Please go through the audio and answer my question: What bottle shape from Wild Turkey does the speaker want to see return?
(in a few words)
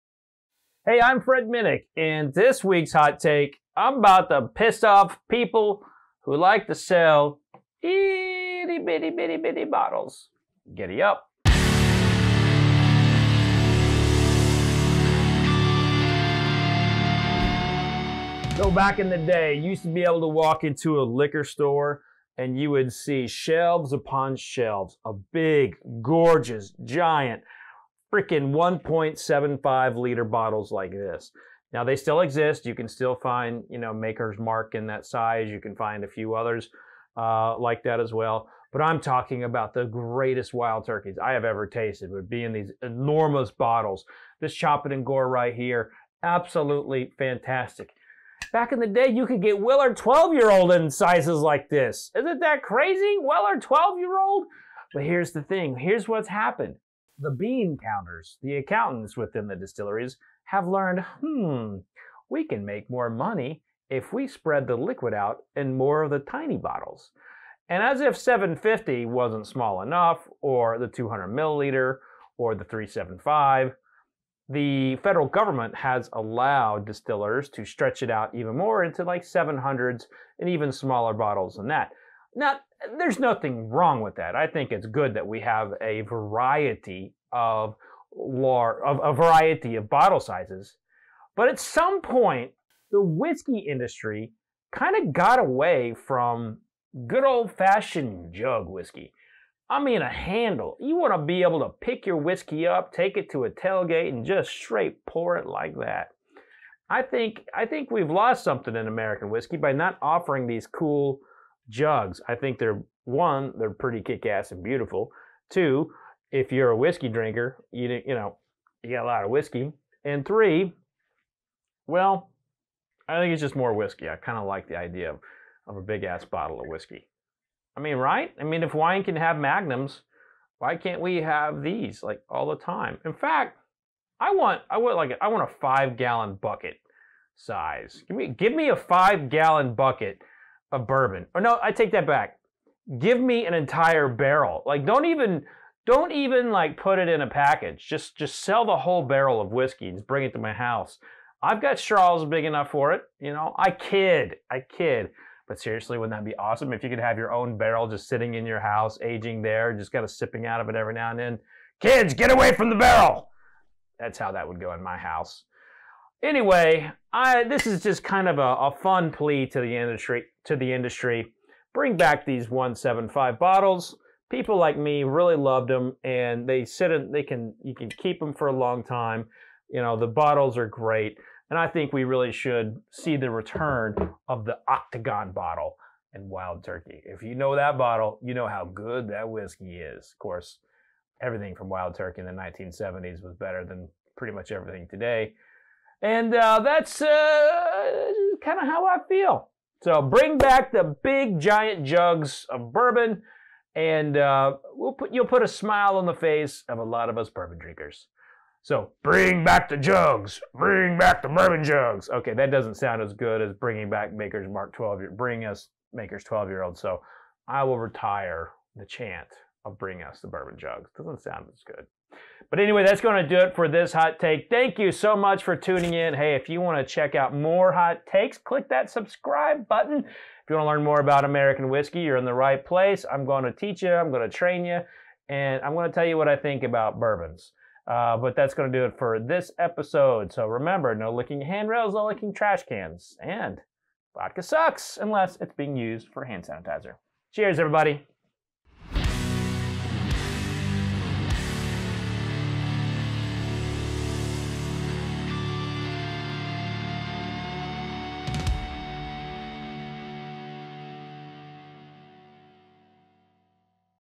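Octagon bottle.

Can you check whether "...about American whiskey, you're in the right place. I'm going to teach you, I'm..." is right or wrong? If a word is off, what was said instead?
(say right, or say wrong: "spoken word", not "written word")
right.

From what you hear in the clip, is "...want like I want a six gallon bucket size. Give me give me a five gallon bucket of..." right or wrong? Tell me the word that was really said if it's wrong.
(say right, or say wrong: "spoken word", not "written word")
wrong: "five", not "six".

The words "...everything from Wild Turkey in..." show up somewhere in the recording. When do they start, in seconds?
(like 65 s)
191 s.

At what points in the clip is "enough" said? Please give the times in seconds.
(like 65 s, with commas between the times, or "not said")
69 s, 152 s.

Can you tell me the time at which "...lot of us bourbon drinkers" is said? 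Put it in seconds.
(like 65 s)
206 s.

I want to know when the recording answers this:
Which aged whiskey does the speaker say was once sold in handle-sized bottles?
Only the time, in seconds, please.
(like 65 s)
49 s.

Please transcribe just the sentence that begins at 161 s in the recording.
Kids, get away from the barrel.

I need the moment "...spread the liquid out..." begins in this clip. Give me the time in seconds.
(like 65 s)
64 s.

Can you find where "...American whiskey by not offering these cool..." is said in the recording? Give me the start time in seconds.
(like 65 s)
108 s.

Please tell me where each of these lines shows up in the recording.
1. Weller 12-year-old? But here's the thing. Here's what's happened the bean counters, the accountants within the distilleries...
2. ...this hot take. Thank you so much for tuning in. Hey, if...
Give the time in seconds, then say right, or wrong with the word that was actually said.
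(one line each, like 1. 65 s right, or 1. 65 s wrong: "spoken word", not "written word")
1. 53 s right
2. 223 s right.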